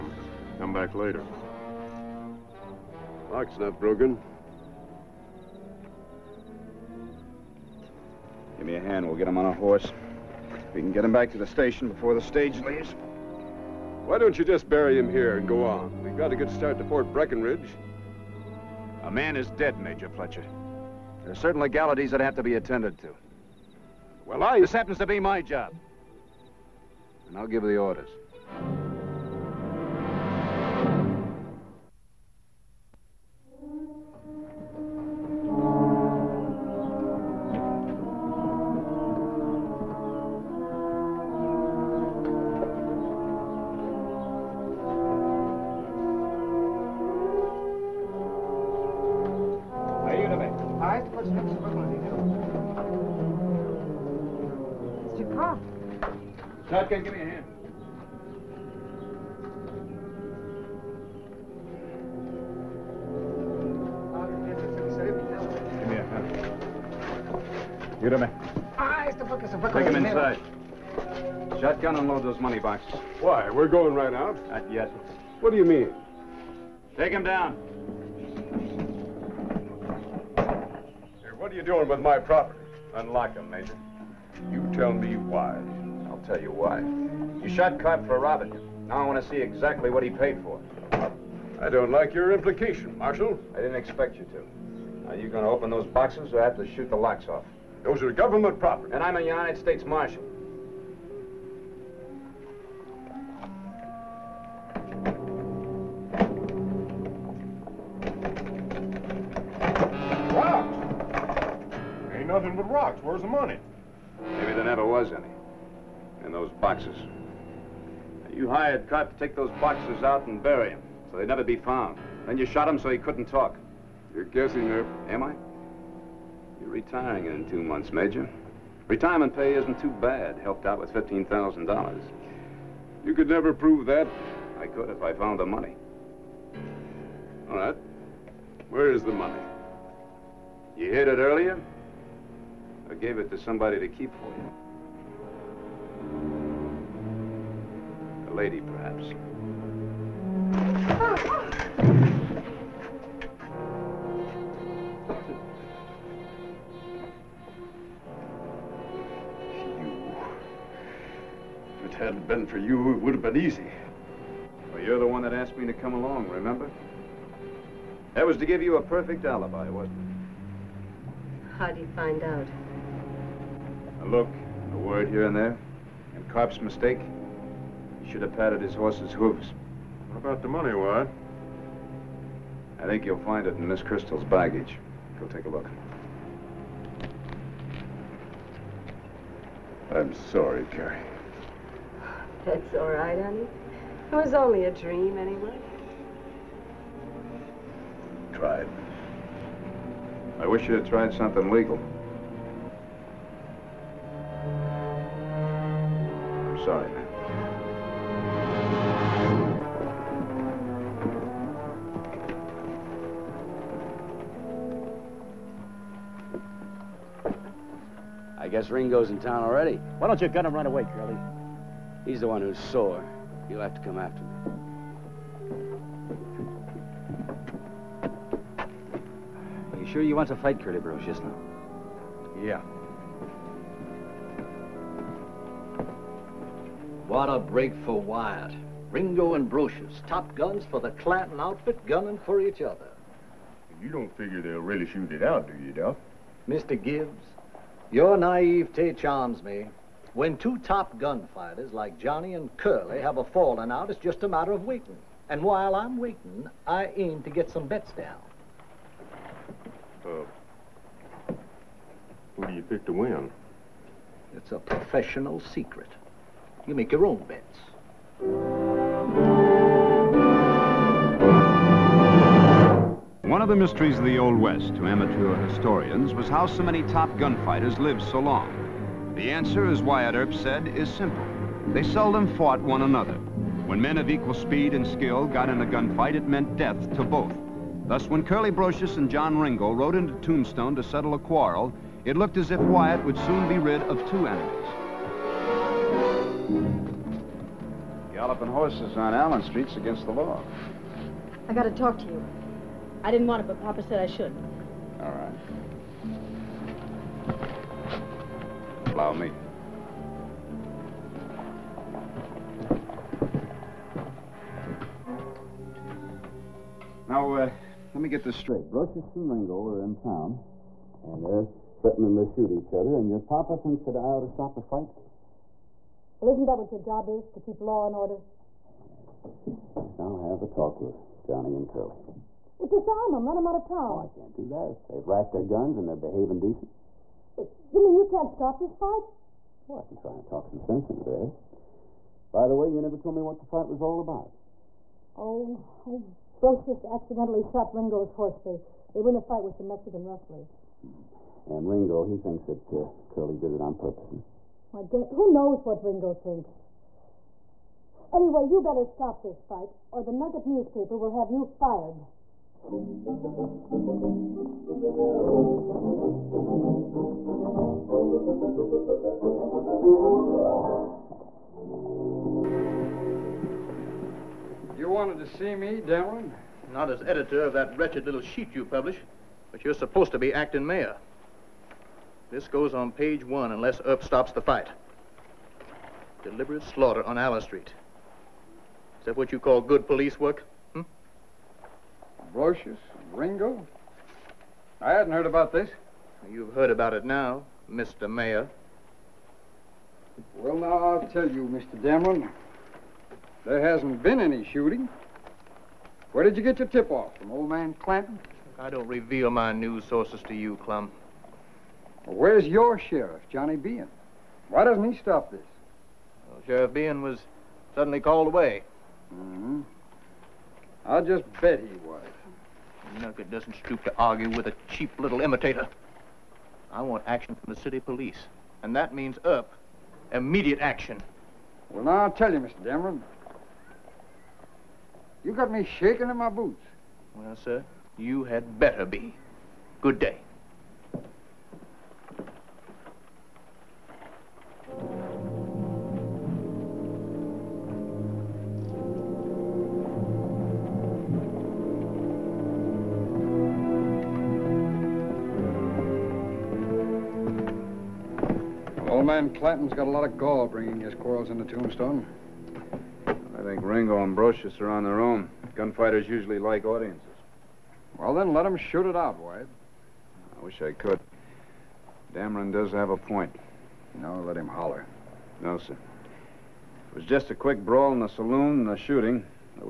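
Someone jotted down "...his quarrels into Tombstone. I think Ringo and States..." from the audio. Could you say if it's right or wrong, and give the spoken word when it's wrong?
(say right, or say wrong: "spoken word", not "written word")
wrong: "Brocious", not "States".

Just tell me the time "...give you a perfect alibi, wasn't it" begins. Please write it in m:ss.
2:48.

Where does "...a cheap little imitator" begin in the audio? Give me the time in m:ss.
7:04.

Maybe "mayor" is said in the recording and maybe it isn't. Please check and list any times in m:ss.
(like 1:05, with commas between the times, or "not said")
6:20, 6:38.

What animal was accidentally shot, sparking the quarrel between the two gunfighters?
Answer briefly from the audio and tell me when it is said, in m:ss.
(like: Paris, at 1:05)
Ringo's horse, at 5:47.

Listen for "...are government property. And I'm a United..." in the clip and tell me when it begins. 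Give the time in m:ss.
1:38.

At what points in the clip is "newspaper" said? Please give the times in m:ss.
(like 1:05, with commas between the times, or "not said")
6:00.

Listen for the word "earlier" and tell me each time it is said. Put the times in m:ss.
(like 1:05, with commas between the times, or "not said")
2:21.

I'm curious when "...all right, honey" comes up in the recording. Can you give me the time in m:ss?
3:12.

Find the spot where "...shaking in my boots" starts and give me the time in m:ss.
7:15.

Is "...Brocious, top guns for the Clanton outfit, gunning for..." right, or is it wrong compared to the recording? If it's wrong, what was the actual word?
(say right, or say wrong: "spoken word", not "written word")
right.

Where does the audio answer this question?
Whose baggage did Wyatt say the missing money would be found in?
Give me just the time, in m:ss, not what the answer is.
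3:03.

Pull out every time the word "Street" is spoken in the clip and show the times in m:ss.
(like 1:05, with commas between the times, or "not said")
4:59, 6:27.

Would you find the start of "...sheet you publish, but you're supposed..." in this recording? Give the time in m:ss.
6:18.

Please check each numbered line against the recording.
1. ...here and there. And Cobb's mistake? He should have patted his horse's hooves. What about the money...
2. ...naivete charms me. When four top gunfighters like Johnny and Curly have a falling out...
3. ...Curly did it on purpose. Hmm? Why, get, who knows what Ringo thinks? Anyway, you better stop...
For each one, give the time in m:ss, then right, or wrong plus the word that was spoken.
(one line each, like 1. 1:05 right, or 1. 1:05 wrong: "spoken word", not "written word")
1. 2:55 right
2. 4:08 wrong: "two", not "four"
3. 5:53 right.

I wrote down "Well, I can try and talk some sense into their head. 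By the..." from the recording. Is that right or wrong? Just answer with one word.
right.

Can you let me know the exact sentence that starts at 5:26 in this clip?
Well, isn't that what your job is, to keep law and order?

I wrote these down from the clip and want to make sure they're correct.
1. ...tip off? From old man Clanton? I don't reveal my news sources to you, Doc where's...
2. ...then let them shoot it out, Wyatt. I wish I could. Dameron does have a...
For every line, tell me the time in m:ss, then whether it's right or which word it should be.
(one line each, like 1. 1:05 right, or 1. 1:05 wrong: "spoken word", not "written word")
1. 6:46 wrong: "Clum", not "Doc"
2. 7:48 right.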